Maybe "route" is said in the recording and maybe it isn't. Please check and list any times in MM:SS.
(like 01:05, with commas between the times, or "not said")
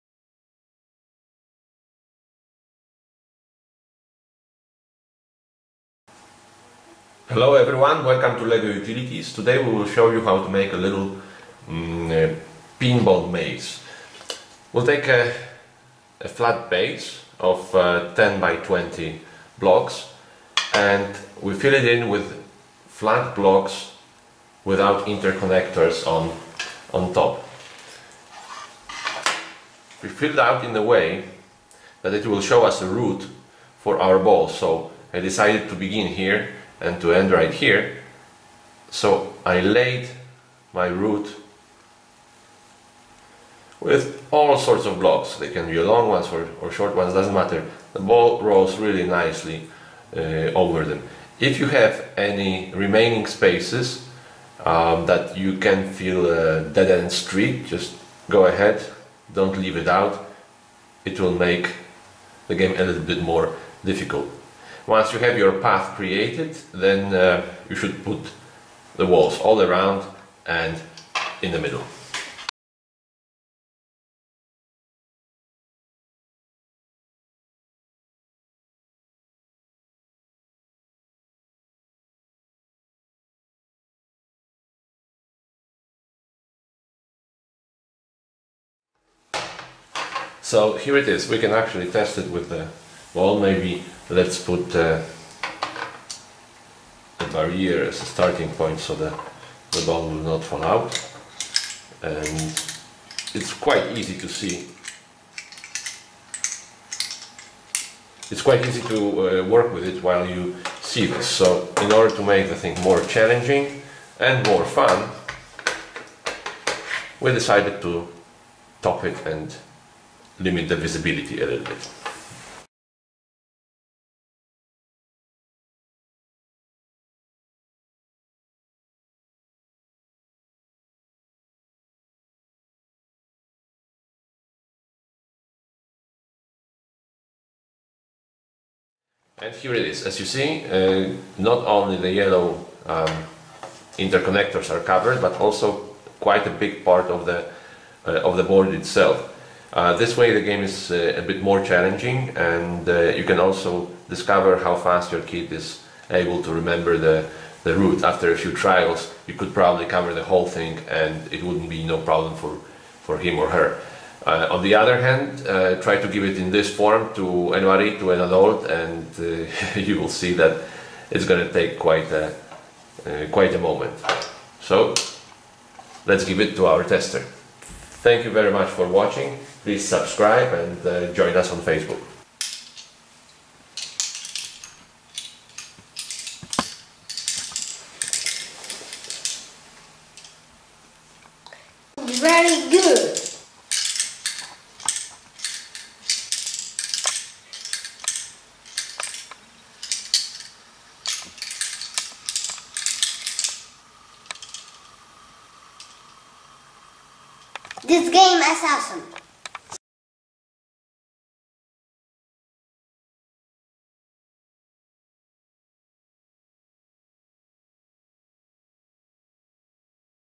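00:32, 00:40, 02:37.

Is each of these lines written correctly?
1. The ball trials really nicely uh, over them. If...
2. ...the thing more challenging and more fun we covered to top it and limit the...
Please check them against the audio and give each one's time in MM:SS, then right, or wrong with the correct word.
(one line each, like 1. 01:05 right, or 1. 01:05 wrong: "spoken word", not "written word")
1. 00:47 wrong: "rolls", not "trials"
2. 01:52 wrong: "decided", not "covered".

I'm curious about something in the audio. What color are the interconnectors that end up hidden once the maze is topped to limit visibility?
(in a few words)
yellow.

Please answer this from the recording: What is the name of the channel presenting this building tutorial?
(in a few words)
LEGO Utilities.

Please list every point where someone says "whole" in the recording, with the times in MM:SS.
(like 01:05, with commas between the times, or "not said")
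02:40.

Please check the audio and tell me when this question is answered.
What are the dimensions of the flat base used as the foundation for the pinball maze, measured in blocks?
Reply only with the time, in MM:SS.
00:18.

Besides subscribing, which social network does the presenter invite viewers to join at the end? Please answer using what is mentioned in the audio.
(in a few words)
Facebook.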